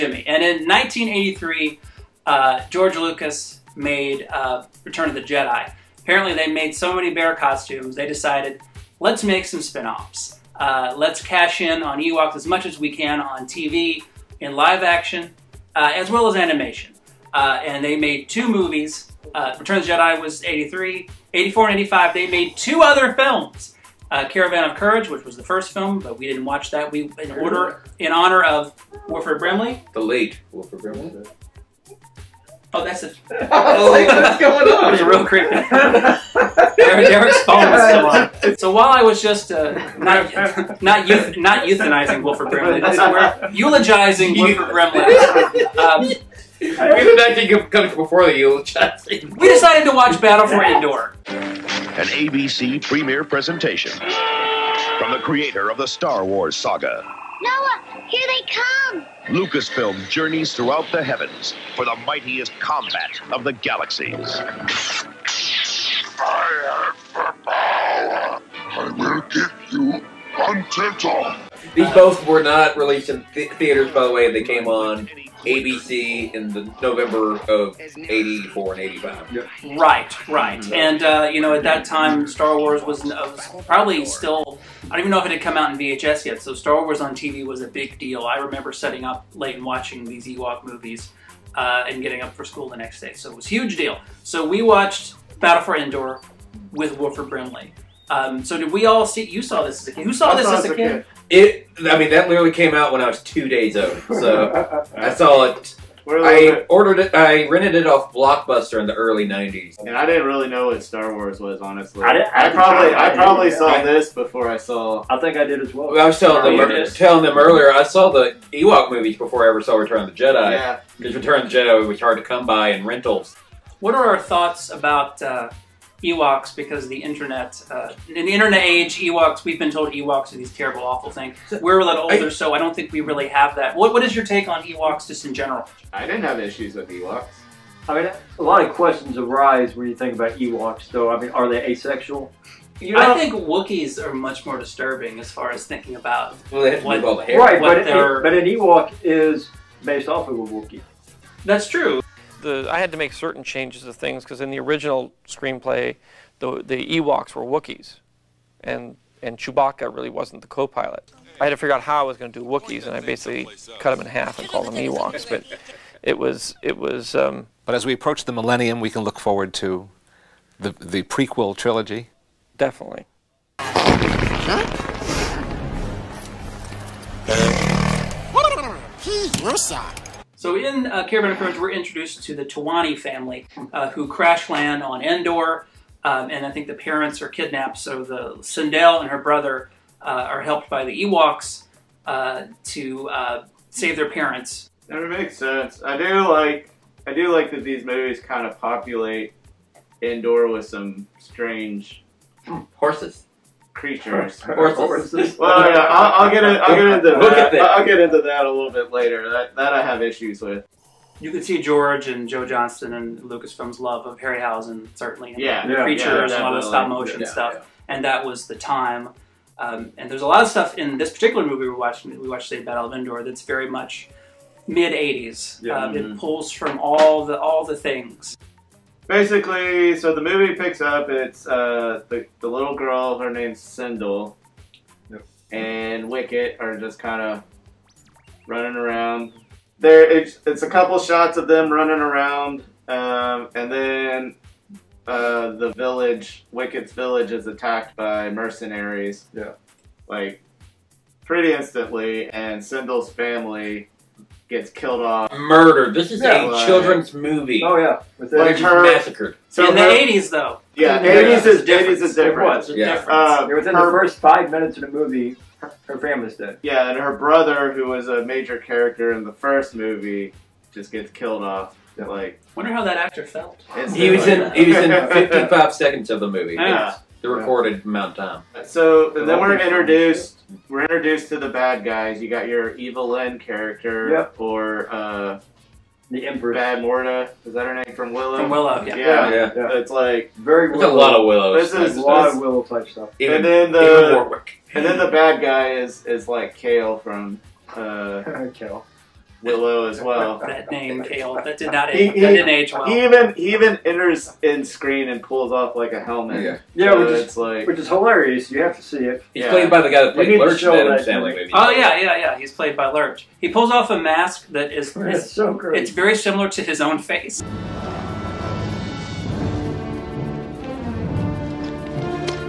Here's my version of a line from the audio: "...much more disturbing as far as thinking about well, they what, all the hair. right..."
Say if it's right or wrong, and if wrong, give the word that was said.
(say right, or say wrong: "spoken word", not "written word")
right.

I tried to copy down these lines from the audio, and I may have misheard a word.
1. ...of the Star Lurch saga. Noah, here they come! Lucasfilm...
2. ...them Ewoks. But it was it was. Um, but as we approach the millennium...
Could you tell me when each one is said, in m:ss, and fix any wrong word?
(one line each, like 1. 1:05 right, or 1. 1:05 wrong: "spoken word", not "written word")
1. 0:55 wrong: "Wars", not "Lurch"
2. 2:44 right.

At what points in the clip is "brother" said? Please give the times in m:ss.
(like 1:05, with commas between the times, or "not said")
3:09, 4:27.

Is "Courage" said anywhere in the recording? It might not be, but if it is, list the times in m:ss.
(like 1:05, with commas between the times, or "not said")
0:24, 3:01.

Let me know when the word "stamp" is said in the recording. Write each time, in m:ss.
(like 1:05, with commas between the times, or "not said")
not said.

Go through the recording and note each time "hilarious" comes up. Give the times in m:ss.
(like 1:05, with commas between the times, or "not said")
5:07.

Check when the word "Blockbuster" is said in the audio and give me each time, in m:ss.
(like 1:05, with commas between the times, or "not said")
1:48.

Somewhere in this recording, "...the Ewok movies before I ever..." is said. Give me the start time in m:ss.
1:58.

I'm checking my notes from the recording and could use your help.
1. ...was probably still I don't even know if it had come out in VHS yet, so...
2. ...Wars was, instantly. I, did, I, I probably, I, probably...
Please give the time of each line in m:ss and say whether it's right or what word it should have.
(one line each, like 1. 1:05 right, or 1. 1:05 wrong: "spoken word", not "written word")
1. 1:23 right
2. 1:51 wrong: "honestly", not "instantly".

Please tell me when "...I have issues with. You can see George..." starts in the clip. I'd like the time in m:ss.
3:29.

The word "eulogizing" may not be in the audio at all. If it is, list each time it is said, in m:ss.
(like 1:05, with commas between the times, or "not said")
0:43, 0:48.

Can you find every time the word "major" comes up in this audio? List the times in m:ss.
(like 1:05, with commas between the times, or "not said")
4:28.